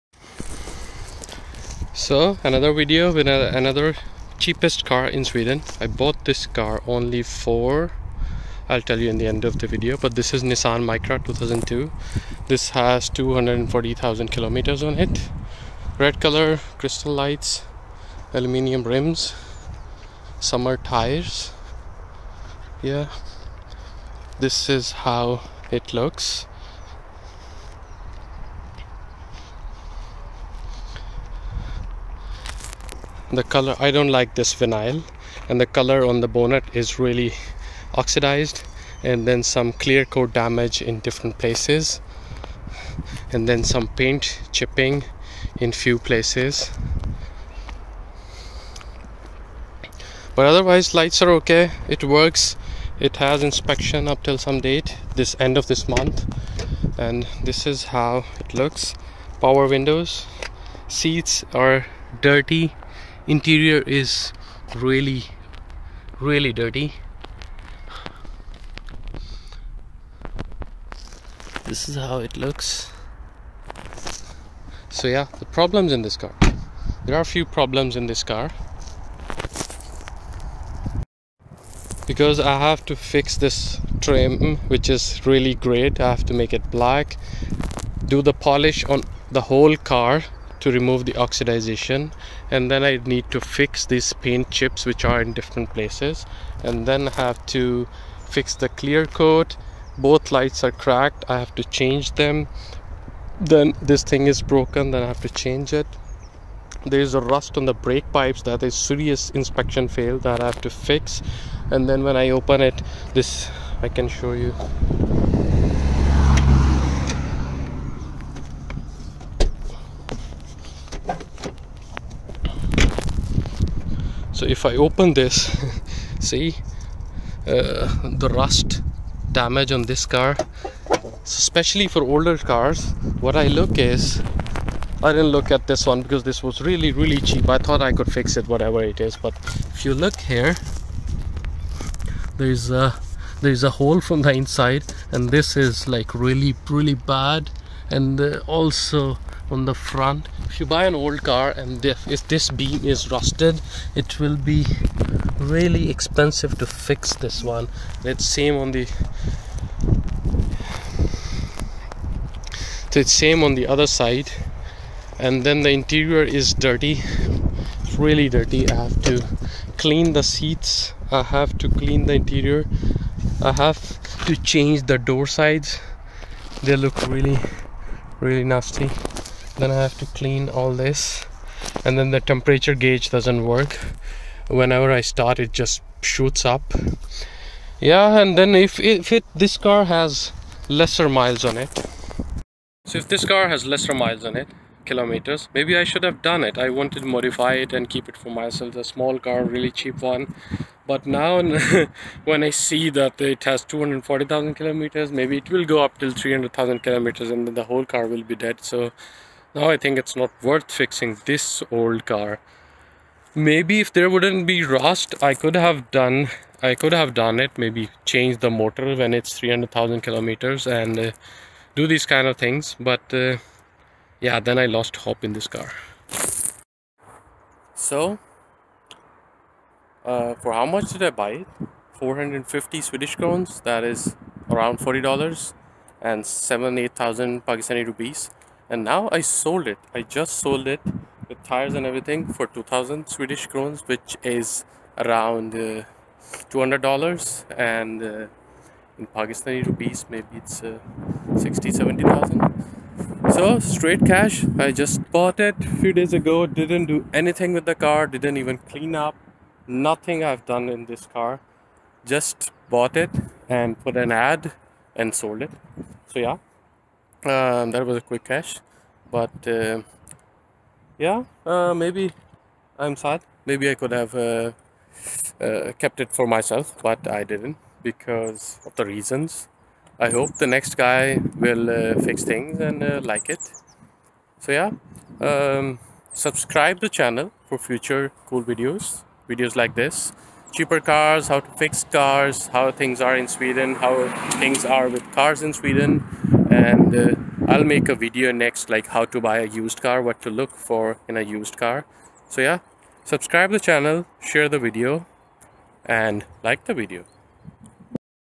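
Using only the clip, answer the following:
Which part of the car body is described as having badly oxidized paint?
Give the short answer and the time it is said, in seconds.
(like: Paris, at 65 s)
bonnet, at 36 s.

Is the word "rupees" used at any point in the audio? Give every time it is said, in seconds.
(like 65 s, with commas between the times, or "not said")
237 s, 249 s.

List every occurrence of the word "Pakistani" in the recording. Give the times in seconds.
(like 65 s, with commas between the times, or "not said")
237 s, 249 s.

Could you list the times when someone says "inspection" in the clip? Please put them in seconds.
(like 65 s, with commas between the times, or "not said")
53 s, 109 s.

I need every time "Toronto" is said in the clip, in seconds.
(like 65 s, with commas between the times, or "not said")
not said.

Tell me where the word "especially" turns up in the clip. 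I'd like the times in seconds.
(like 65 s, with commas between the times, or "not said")
131 s.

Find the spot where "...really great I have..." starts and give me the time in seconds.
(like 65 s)
85 s.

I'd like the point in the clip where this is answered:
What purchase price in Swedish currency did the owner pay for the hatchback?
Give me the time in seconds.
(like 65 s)
231 s.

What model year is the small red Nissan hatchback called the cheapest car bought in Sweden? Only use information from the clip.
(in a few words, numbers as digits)
2002.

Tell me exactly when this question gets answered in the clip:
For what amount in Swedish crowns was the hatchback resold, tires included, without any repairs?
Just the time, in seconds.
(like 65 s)
242 s.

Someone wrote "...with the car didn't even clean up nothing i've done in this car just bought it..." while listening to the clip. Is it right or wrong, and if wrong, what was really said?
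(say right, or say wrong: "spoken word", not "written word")
right.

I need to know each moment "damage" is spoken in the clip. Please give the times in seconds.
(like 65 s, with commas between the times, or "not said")
40 s, 129 s.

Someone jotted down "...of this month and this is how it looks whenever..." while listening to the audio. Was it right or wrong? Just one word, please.
wrong.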